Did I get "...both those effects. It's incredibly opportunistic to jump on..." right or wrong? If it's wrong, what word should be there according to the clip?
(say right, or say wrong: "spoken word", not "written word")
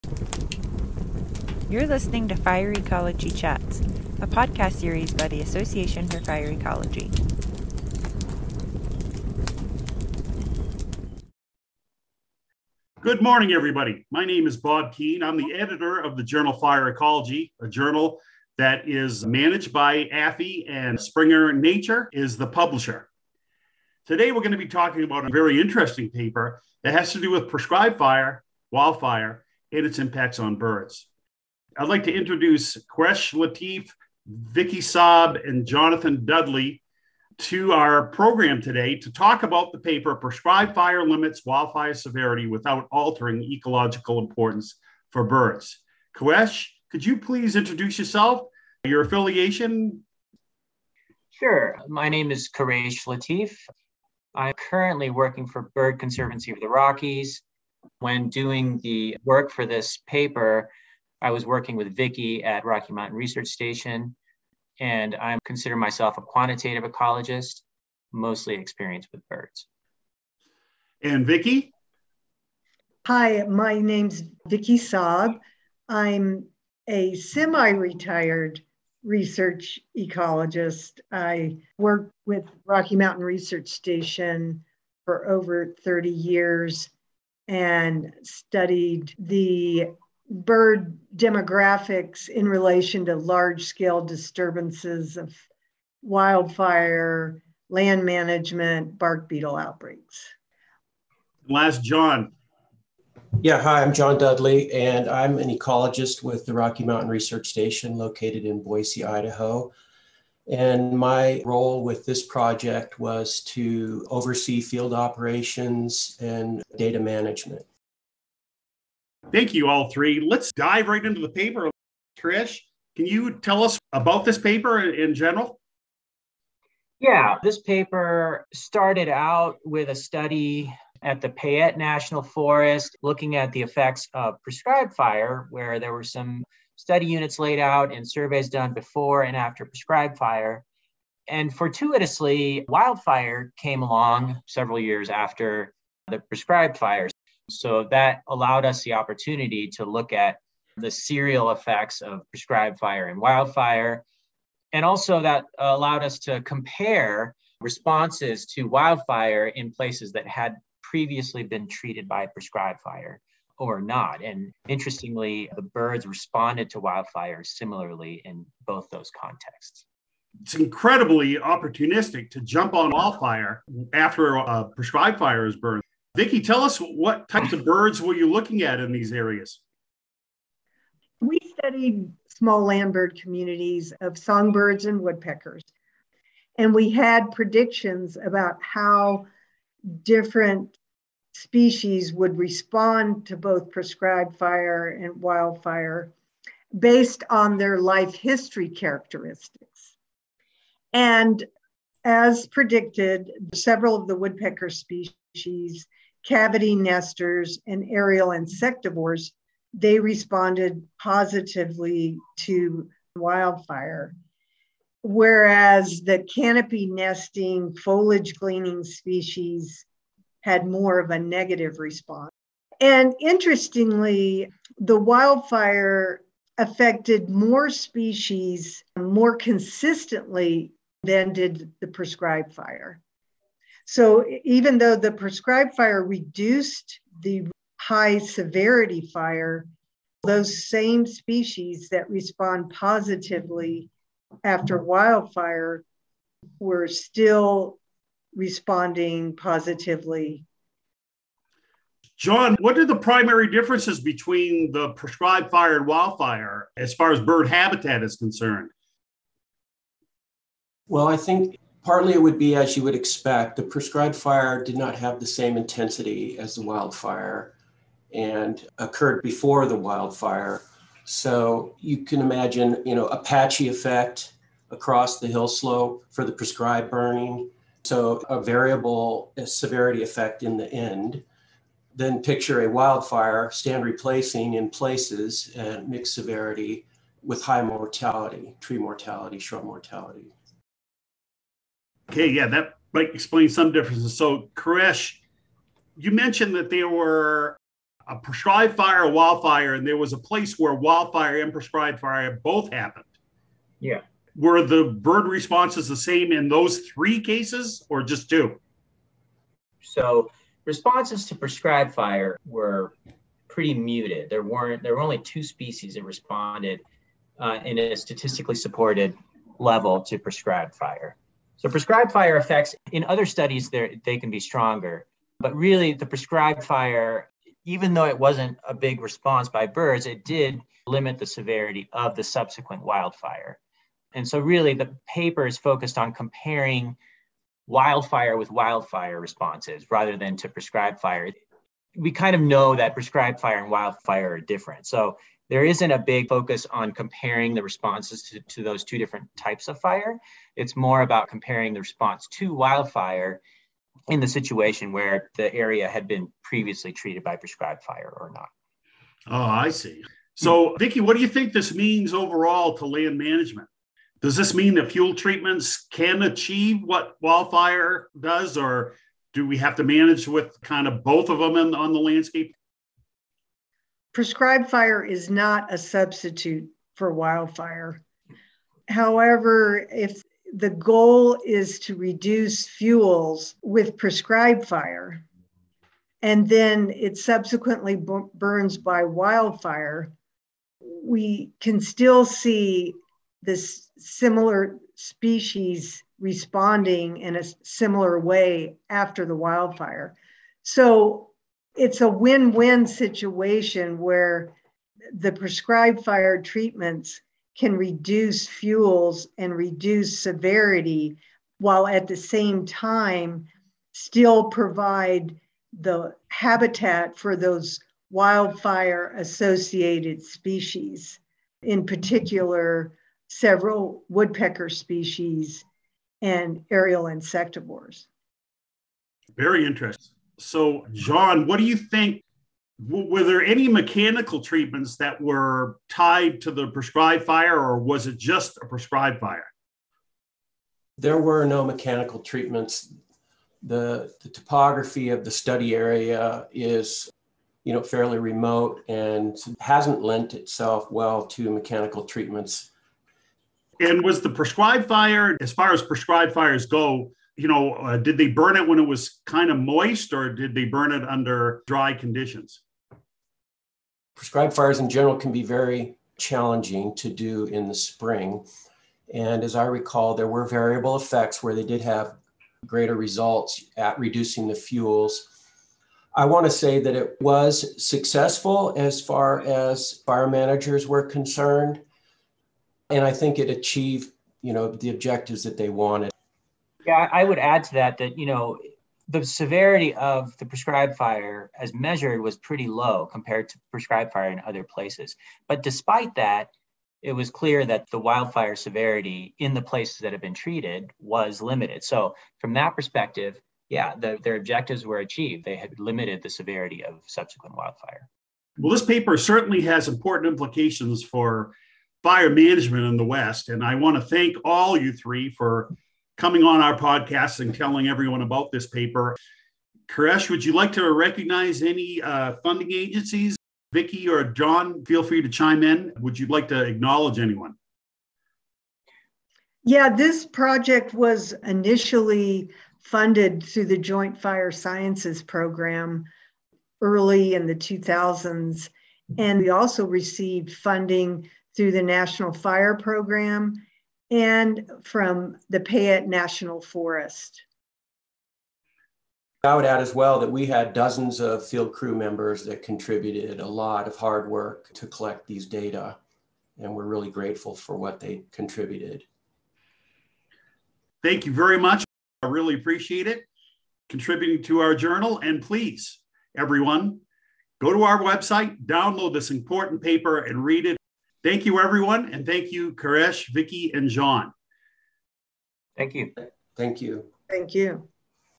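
wrong: "contexts", not "effects".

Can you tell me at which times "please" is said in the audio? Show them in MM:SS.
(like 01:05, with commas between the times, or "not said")
00:47, 09:25.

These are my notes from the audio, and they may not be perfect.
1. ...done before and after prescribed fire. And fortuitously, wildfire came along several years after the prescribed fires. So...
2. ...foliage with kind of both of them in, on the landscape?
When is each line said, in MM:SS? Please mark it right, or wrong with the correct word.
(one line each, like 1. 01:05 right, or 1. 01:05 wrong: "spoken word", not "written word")
1. 02:18 right
2. 06:09 wrong: "manage", not "foliage".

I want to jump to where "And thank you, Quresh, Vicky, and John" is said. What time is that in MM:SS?
09:32.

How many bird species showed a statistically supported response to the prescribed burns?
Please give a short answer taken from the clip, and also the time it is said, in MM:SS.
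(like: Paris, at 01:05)
2, at 05:15.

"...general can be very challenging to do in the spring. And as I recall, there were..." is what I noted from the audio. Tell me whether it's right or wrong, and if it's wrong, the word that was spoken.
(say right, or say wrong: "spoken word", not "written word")
right.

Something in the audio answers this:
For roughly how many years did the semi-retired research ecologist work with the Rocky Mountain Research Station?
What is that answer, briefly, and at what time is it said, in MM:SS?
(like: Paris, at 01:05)
over 30, at 01:25.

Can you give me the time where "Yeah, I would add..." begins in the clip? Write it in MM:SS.
08:06.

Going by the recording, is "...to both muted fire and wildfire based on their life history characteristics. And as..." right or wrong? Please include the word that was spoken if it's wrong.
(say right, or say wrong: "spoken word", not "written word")
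wrong: "prescribed", not "muted".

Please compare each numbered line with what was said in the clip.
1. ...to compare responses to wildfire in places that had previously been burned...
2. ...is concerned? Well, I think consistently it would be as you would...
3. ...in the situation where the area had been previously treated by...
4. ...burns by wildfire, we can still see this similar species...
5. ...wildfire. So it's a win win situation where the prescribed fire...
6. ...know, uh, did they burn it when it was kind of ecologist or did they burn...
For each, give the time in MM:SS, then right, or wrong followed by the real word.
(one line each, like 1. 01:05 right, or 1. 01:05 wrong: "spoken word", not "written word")
1. 02:36 wrong: "treated", not "burned"
2. 04:18 wrong: "partly", not "consistently"
3. 05:54 right
4. 06:28 right
5. 06:39 right
6. 07:37 wrong: "moist", not "ecologist".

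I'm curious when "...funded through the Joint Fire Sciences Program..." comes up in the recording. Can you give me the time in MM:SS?
08:52.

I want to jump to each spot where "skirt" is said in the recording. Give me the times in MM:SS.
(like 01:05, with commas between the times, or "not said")
not said.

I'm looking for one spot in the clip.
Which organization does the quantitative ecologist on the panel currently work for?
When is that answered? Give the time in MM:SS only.
00:55.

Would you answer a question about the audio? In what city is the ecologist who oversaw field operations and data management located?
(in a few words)
Boise, Idaho.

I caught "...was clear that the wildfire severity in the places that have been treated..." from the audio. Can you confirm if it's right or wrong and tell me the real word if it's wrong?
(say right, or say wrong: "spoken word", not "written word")
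right.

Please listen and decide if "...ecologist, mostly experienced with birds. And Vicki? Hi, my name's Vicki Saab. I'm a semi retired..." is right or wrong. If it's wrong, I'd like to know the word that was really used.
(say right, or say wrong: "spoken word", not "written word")
right.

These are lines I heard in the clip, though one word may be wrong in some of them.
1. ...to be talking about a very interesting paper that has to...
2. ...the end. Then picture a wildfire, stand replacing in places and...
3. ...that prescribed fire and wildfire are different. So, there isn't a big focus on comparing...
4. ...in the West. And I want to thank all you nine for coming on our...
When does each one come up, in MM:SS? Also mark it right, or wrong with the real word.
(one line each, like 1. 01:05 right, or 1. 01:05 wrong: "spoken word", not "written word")
1. 00:24 right
2. 04:40 right
3. 05:42 right
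4. 08:32 wrong: "three", not "nine".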